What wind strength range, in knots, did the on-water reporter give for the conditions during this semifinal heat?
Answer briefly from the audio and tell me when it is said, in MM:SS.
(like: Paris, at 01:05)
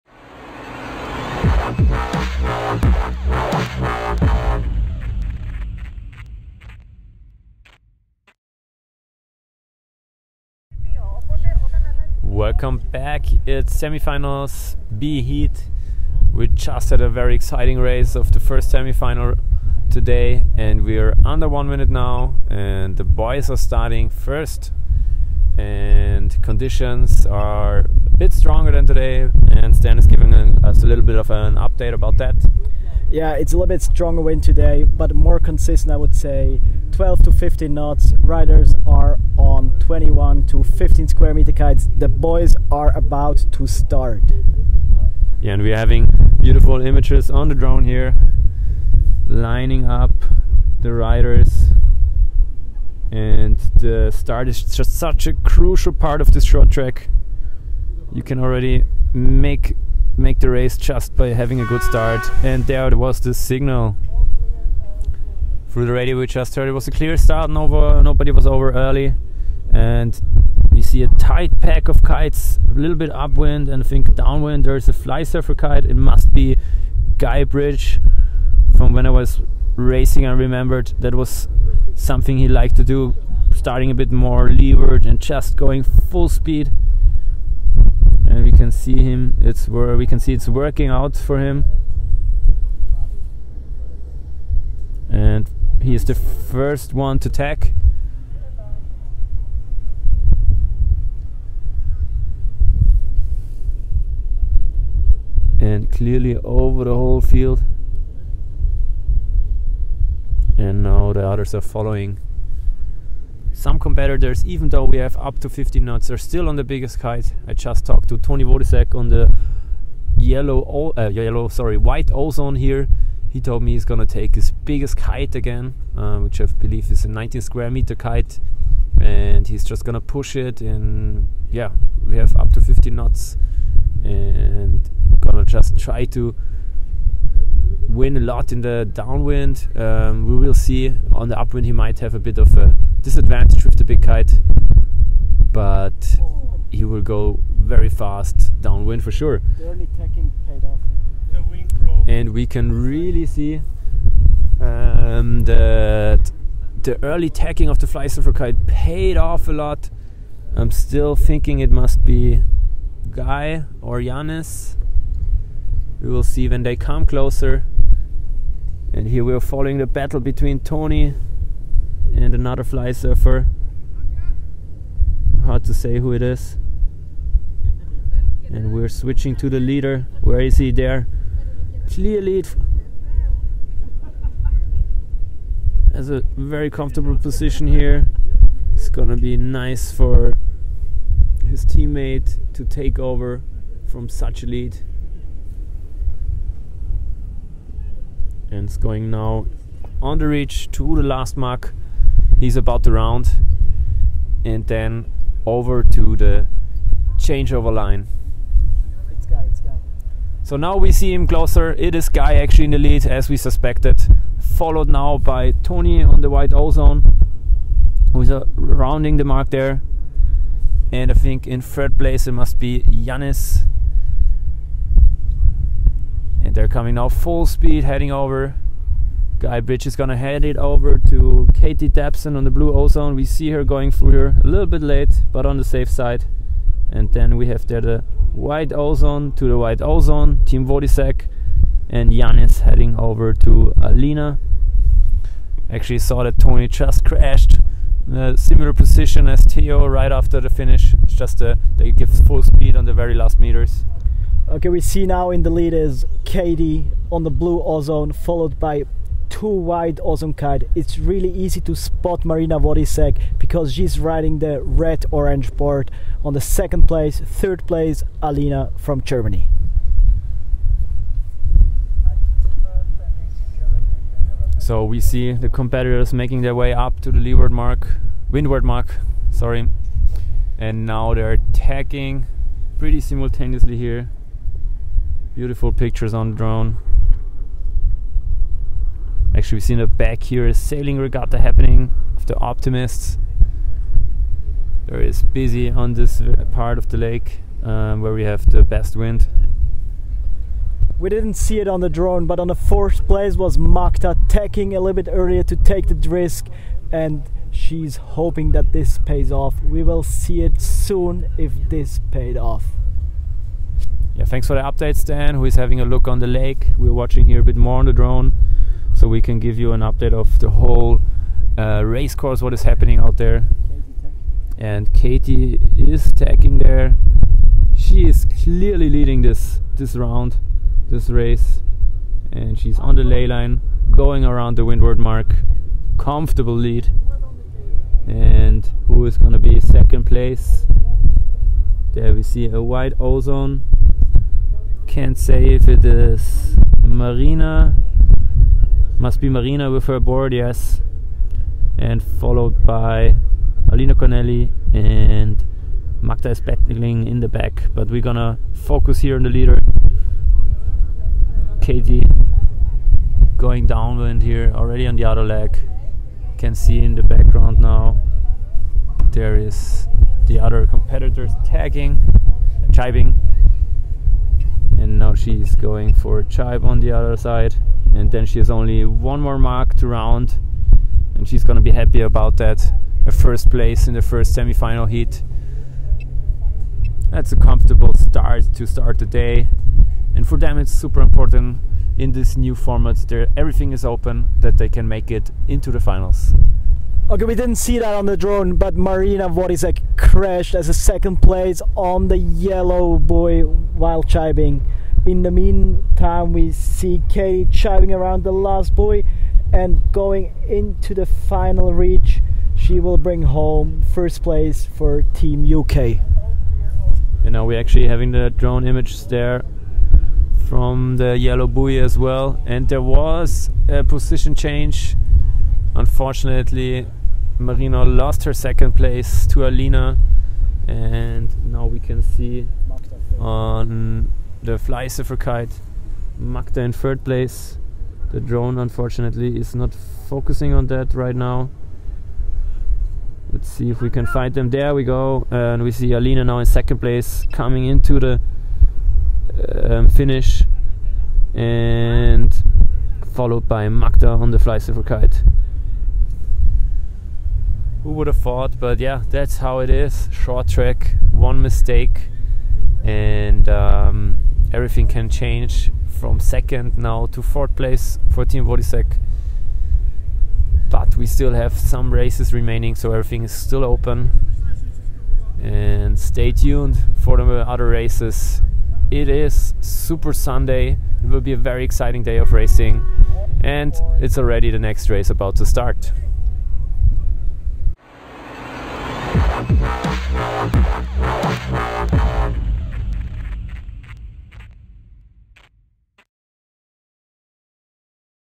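12 to 15 knots, at 00:36.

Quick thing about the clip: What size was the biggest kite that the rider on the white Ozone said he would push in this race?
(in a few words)
19 square meters.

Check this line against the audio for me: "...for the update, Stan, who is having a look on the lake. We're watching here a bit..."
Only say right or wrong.
right.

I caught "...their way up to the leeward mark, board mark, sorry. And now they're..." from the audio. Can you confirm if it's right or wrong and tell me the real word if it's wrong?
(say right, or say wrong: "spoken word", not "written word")
wrong: "windward", not "board".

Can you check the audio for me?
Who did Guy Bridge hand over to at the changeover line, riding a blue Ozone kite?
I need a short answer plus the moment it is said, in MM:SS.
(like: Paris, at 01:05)
Katie Dabson, at 03:51.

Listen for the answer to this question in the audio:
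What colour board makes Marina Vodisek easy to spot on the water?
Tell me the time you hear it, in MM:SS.
04:24.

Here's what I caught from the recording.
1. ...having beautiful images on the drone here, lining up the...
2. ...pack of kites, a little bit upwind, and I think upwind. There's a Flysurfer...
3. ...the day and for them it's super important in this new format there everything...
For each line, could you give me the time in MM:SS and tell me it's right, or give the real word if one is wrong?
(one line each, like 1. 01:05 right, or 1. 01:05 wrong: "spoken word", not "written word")
1. 00:45 right
2. 01:11 wrong: "downwind", not "upwind"
3. 06:28 right.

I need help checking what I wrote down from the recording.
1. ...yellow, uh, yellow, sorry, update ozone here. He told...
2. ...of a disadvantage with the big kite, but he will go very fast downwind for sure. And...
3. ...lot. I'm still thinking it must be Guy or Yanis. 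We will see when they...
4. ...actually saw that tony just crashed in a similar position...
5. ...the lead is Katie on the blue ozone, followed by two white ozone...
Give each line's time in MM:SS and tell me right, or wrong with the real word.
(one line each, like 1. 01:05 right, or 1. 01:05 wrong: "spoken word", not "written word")
1. 02:00 wrong: "white", not "update"
2. 02:22 right
3. 02:39 right
4. 04:05 right
5. 04:15 right.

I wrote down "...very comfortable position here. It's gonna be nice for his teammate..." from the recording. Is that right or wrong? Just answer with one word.
right.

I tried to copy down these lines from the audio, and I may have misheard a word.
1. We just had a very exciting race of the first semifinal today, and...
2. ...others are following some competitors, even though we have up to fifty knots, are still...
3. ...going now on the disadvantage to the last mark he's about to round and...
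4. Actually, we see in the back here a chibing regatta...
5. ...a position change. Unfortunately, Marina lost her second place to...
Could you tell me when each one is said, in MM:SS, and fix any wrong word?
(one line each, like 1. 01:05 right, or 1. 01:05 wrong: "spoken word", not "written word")
1. 00:16 right
2. 01:51 right
3. 03:18 wrong: "ridge", not "disadvantage"
4. 04:49 wrong: "sailing", not "chibing"
5. 07:03 right.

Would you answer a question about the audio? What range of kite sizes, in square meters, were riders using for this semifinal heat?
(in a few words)
21 to 15 square meters.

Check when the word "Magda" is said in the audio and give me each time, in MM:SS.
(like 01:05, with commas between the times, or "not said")
05:03, 05:56, 07:16, 07:33.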